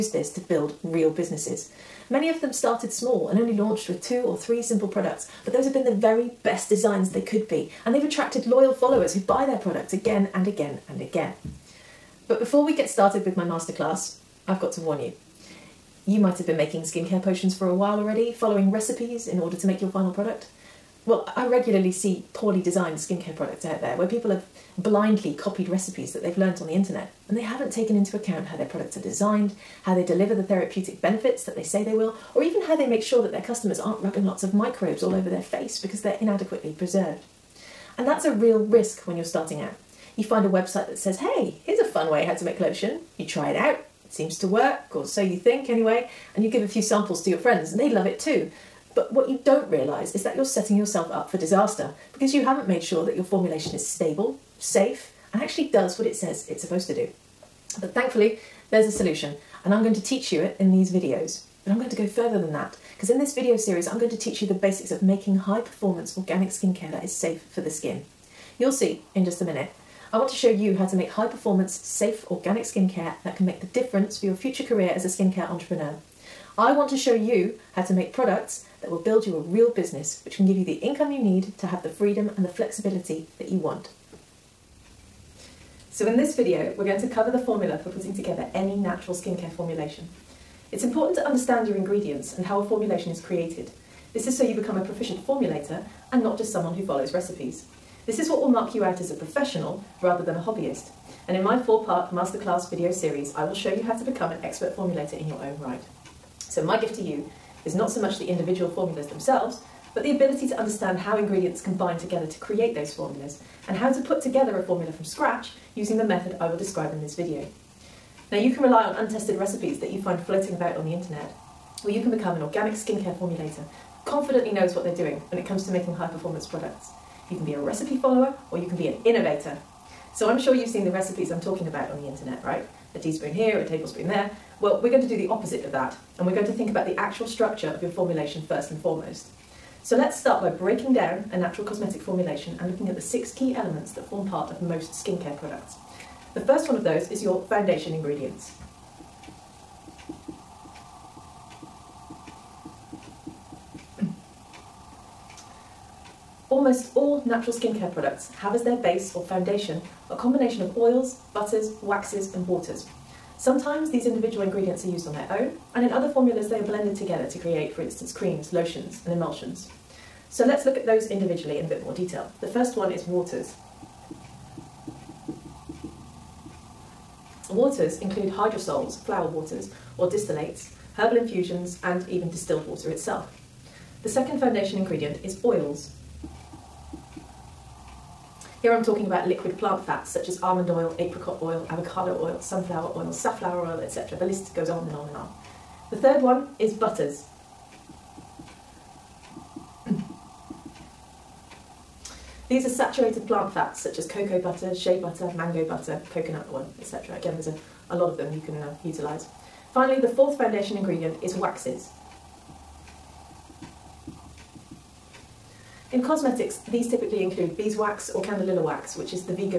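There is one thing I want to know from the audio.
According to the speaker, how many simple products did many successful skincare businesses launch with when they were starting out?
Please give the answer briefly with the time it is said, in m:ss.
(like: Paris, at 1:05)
2 or 3, at 0:04.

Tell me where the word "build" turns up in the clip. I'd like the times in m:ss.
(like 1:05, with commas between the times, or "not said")
0:00, 1:19.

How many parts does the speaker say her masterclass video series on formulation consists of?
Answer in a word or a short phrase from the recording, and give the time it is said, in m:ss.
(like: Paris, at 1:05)
4, at 1:41.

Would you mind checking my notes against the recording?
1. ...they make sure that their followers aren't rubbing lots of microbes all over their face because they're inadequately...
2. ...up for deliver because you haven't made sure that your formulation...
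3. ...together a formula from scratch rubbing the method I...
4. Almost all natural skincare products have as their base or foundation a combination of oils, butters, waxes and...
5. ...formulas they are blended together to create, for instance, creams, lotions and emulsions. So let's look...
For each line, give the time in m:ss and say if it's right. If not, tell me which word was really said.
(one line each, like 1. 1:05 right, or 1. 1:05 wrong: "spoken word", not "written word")
1. 0:32 wrong: "customers", not "followers"
2. 0:51 wrong: "disaster", not "deliver"
3. 1:54 wrong: "using", not "rubbing"
4. 2:36 right
5. 2:46 right.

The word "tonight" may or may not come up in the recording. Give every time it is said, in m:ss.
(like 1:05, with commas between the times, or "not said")
not said.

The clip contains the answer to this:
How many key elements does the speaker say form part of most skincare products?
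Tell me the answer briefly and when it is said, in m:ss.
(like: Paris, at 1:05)
6, at 2:22.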